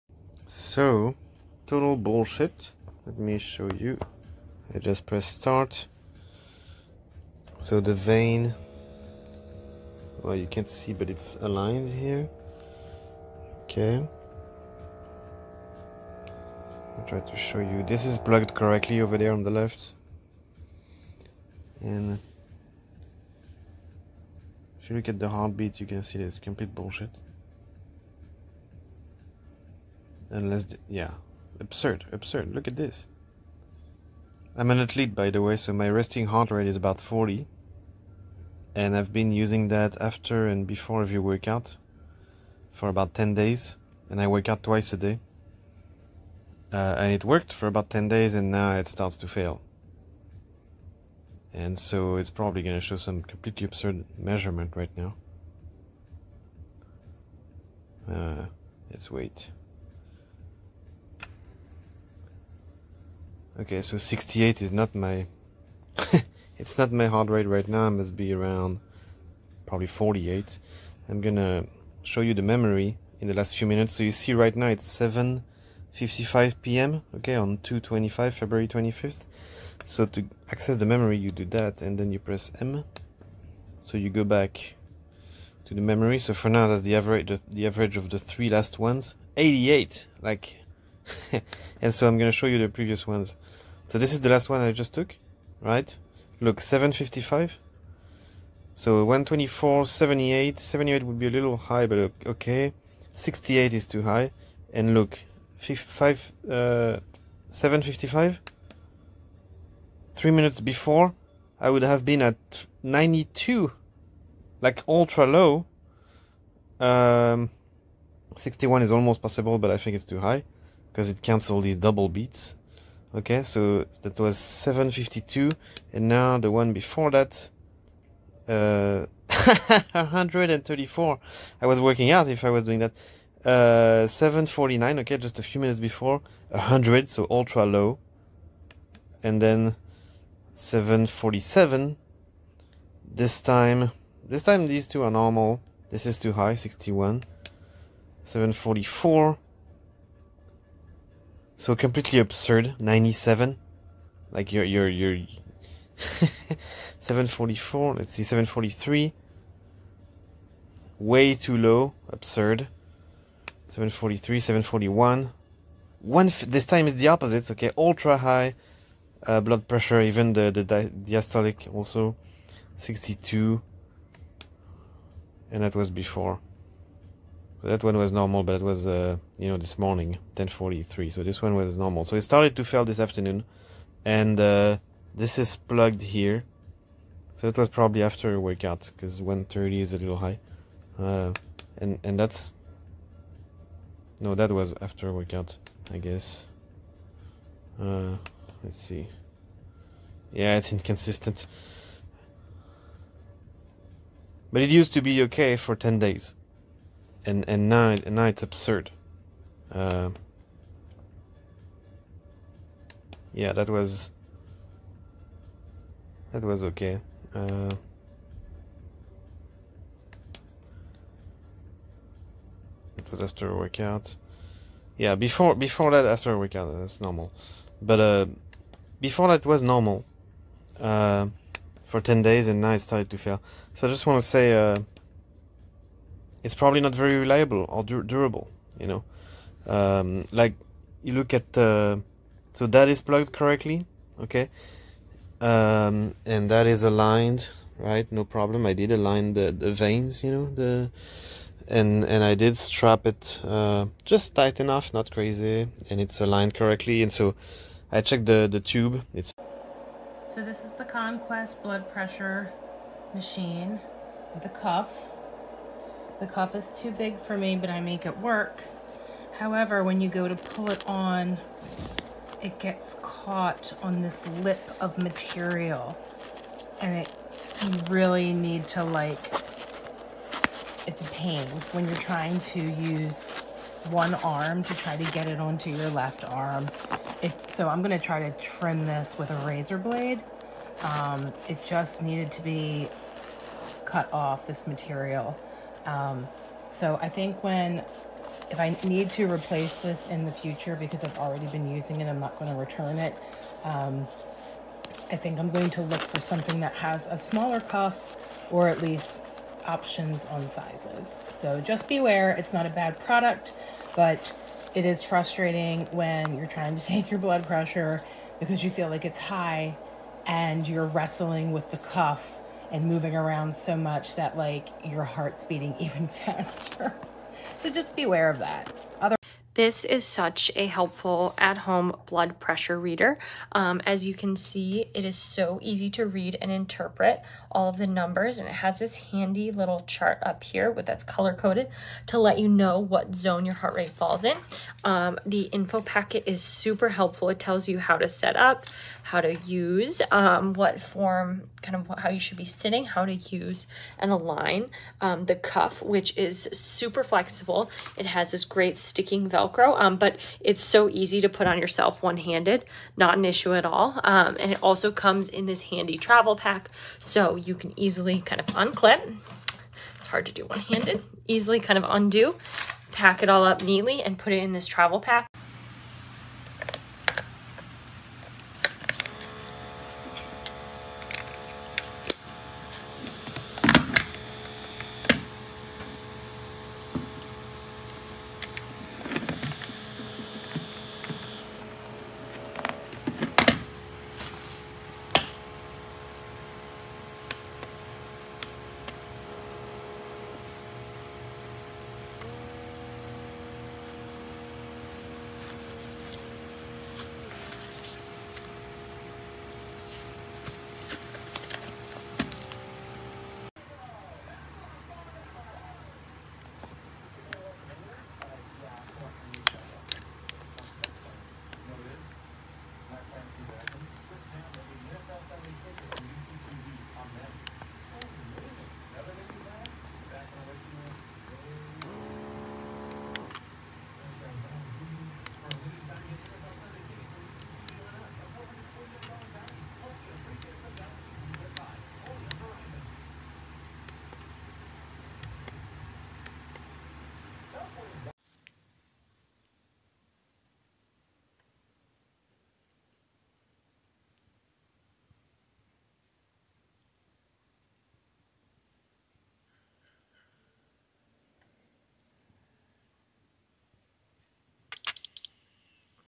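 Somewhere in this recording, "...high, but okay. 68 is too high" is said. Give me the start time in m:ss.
1:41.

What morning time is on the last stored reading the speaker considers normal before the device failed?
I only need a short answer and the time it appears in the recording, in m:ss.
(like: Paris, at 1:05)
10:43, at 3:00.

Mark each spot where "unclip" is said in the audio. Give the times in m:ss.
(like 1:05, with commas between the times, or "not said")
6:08.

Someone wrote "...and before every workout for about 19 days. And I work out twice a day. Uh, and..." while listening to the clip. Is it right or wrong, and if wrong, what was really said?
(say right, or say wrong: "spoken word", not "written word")
wrong: "10", not "19".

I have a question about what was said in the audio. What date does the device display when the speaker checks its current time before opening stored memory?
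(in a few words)
February 25th.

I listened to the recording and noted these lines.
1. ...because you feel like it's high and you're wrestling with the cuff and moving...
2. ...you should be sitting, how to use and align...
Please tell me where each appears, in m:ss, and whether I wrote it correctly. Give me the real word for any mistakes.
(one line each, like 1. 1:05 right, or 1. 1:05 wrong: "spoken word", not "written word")
1. 5:18 right
2. 5:52 right.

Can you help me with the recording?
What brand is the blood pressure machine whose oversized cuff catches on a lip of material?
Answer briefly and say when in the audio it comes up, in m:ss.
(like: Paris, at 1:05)
Konquest, at 4:20.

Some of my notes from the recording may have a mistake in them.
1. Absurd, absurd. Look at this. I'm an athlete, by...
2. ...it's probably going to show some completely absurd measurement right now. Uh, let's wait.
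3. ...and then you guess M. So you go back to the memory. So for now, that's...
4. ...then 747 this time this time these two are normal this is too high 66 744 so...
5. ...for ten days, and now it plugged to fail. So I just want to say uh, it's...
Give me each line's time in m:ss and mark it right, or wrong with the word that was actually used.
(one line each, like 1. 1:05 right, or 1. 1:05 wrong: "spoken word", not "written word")
1. 0:31 right
2. 0:52 right
3. 1:21 wrong: "press", not "guess"
4. 2:19 wrong: "61", not "66"
5. 3:51 wrong: "started", not "plugged".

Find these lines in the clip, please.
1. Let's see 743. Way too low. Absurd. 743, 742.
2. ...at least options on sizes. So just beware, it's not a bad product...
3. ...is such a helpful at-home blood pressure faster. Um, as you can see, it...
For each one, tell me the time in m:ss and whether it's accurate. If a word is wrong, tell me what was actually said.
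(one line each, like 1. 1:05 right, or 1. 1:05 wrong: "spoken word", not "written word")
1. 2:37 wrong: "741", not "742"
2. 5:08 right
3. 5:29 wrong: "reader", not "faster".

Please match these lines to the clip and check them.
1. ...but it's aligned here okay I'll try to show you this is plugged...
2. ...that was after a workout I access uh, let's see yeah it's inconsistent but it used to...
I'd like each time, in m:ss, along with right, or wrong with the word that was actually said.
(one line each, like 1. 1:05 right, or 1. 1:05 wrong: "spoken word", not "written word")
1. 0:10 right
2. 3:14 wrong: "guess", not "access".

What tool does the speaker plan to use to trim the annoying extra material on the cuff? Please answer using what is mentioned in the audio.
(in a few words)
Razor blade.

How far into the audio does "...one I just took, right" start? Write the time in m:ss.
1:34.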